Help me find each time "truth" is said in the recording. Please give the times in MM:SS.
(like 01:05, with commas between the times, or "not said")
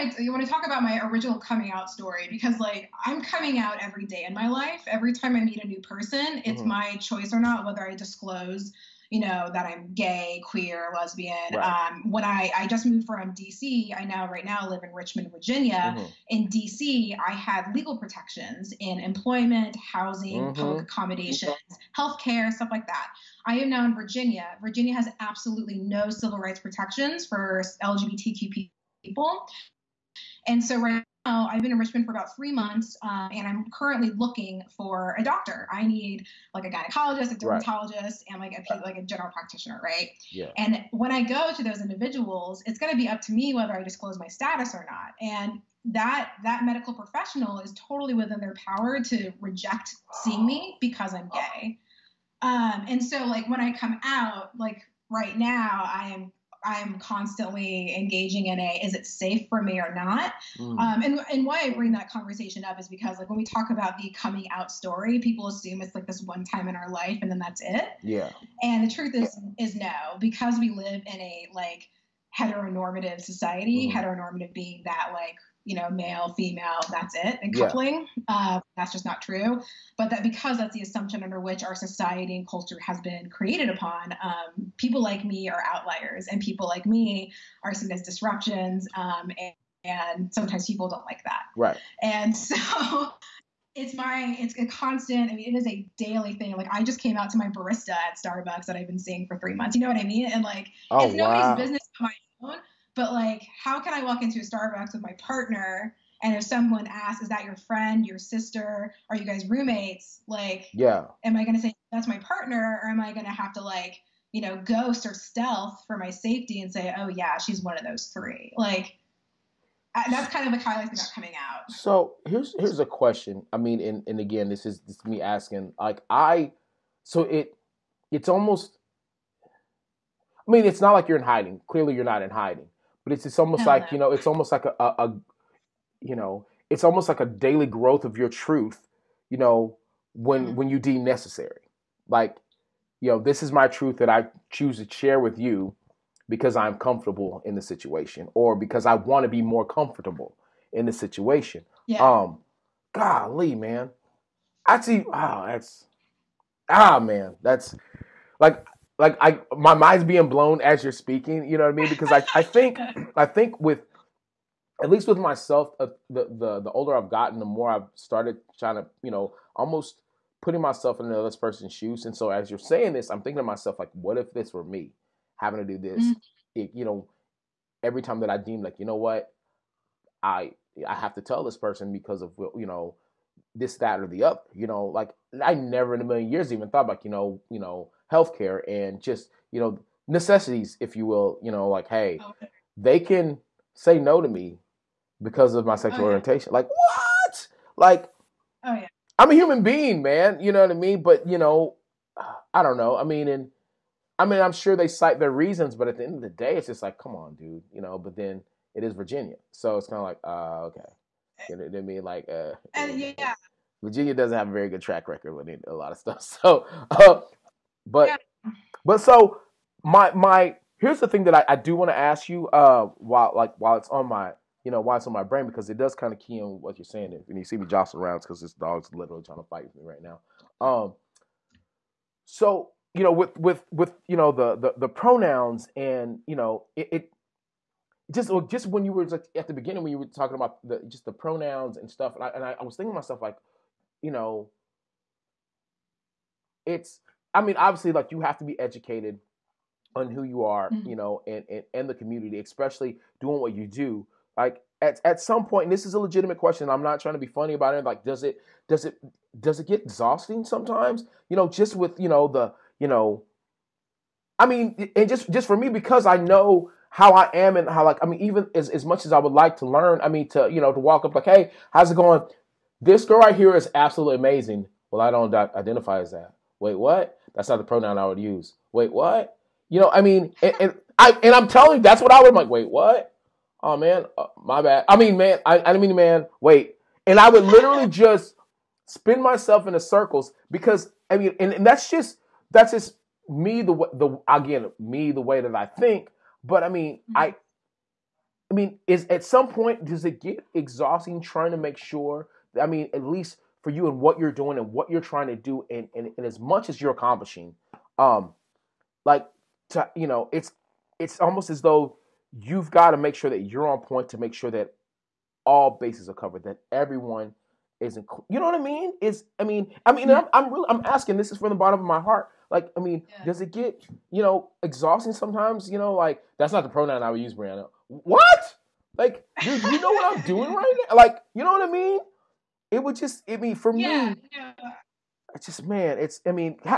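01:08, 02:18, 02:23.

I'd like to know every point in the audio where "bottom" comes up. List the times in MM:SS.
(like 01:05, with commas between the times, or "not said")
05:21.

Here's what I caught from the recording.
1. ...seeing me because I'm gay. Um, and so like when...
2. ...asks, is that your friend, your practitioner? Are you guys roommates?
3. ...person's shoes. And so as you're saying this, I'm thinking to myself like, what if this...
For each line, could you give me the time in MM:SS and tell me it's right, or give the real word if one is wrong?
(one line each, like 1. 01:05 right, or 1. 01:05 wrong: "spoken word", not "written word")
1. 00:50 right
2. 01:46 wrong: "sister", not "practitioner"
3. 02:51 right.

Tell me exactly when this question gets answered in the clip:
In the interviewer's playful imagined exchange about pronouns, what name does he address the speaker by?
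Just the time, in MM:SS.
05:27.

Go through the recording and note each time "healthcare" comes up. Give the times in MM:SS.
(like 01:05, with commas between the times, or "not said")
00:21, 03:08.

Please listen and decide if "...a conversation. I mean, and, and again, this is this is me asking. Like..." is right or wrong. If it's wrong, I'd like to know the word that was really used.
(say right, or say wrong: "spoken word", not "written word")
wrong: "question", not "conversation".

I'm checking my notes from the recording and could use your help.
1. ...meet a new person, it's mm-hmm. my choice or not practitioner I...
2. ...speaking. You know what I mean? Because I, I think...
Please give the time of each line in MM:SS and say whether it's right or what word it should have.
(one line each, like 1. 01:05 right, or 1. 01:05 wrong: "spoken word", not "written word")
1. 00:05 wrong: "whether", not "practitioner"
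2. 02:40 right.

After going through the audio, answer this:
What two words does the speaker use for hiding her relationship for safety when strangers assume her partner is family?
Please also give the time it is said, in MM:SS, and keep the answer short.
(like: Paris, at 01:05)
Ghost or stealth, at 01:54.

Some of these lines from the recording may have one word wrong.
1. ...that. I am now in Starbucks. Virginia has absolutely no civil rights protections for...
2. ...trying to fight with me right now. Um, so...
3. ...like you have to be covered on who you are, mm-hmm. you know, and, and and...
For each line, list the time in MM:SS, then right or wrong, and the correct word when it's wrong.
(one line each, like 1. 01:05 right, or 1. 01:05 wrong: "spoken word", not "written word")
1. 00:22 wrong: "Virginia", not "Starbucks"
2. 03:49 right
3. 04:07 wrong: "educated", not "covered".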